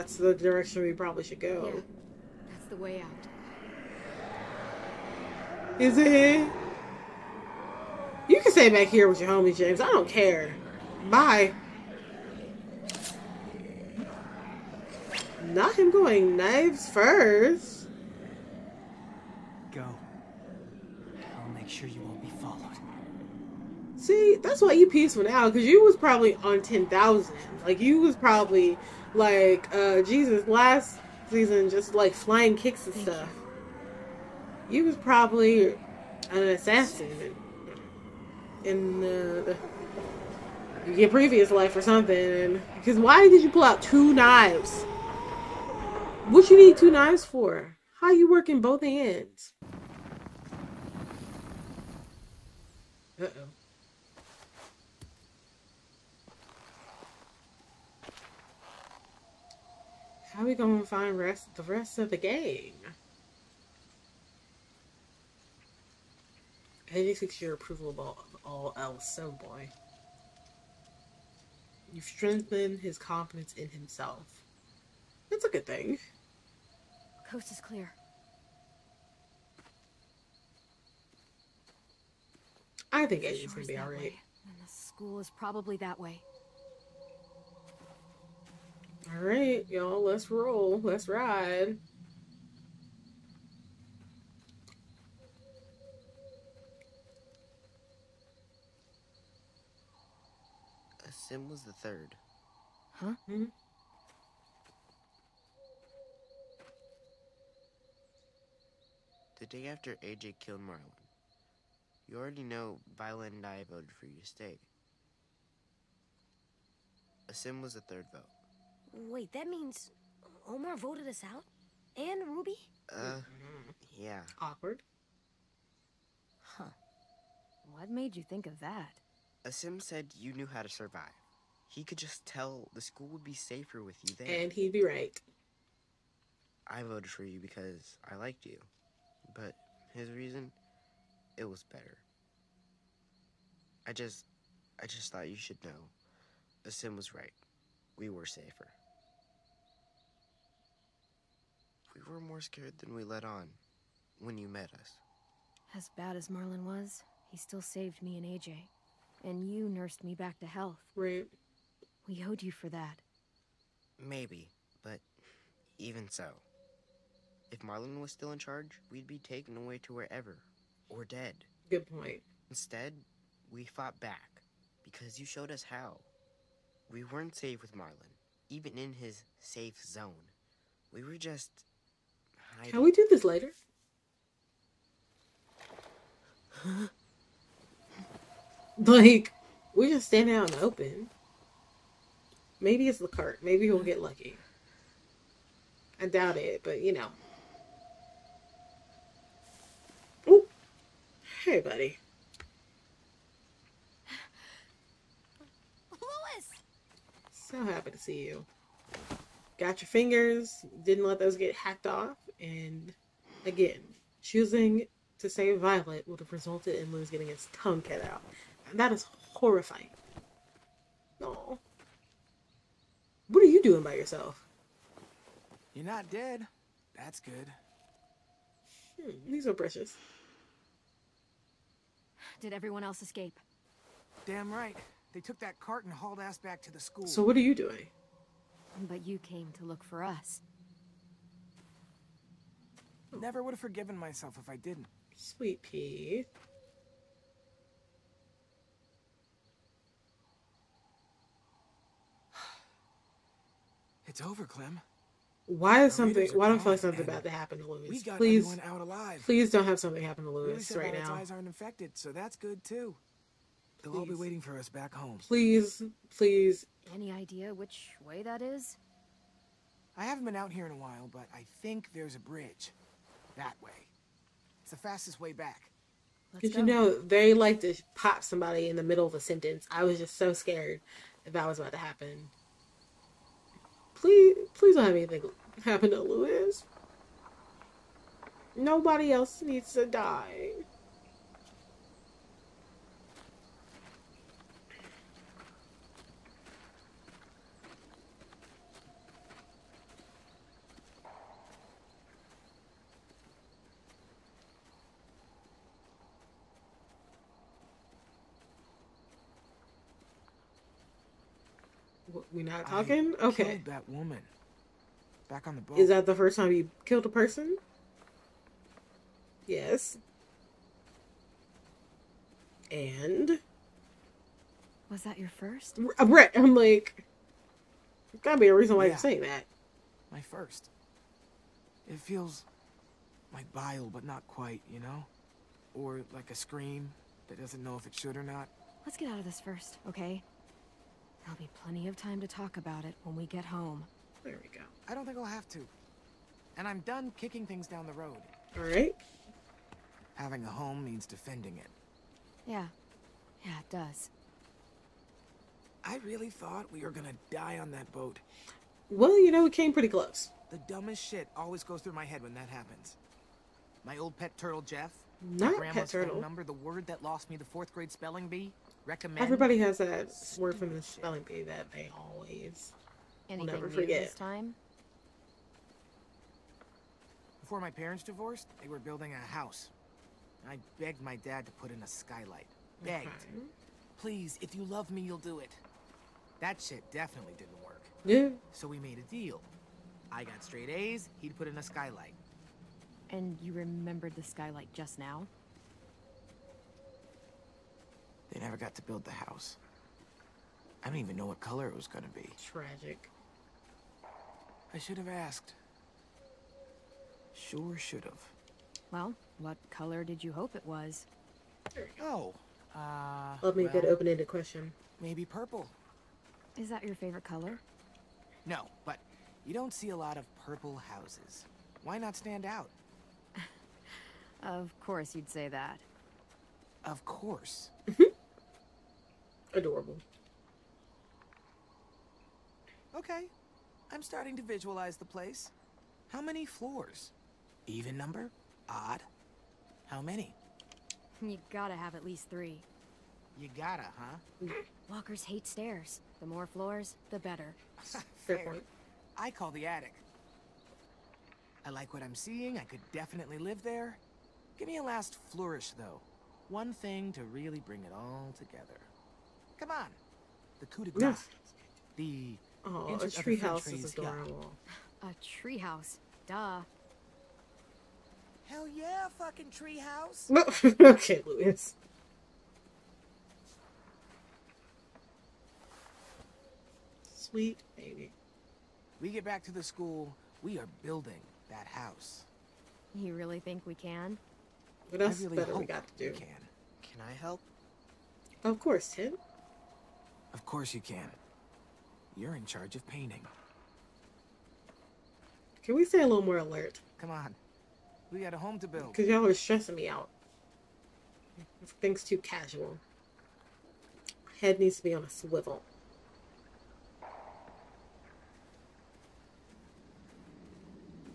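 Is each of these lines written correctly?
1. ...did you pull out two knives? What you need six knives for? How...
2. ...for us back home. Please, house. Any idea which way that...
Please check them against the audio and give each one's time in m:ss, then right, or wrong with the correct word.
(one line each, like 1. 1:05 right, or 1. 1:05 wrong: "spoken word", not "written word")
1. 0:43 wrong: "two", not "six"
2. 4:24 wrong: "please", not "house".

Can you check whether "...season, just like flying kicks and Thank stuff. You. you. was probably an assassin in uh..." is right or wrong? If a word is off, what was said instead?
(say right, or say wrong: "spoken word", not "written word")
right.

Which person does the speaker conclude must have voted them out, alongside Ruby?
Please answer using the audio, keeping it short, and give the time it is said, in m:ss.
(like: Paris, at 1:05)
Omar, at 2:00.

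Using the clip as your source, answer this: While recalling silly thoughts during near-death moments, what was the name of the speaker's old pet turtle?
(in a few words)
Jeff.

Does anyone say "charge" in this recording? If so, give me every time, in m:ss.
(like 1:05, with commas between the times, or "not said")
2:48, 8:12.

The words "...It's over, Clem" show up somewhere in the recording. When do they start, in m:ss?
4:14.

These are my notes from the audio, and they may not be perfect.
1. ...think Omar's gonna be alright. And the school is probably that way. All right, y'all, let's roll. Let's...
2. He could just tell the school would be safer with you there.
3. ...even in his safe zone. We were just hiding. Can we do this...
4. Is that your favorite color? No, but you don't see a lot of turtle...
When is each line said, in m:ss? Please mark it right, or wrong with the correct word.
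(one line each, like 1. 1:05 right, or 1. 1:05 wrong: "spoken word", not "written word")
1. 1:23 wrong: "Aiden", not "Omar"
2. 2:11 right
3. 2:58 right
4. 6:56 wrong: "purple", not "turtle".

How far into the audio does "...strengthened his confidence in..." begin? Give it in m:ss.
1:12.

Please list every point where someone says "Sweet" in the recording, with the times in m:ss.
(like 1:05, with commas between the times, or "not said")
4:05, 7:57.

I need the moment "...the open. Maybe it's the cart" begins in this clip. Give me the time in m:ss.
3:10.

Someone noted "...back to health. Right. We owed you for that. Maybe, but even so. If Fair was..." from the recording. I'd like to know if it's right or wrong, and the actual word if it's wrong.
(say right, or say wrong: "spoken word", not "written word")
wrong: "Marlon", not "Fair".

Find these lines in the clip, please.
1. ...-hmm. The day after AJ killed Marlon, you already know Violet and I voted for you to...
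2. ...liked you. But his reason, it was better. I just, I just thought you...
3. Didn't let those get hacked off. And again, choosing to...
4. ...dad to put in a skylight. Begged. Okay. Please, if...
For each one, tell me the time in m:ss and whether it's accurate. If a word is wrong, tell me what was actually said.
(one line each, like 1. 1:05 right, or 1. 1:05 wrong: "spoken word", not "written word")
1. 1:43 right
2. 2:18 right
3. 3:30 right
4. 6:21 right.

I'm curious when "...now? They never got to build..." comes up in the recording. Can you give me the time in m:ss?
6:34.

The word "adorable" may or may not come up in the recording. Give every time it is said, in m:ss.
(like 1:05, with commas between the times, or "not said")
7:09, 7:43.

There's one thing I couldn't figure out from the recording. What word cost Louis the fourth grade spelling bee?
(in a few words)
Recommend.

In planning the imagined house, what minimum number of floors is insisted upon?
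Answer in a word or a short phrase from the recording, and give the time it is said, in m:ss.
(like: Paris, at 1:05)
3, at 7:22.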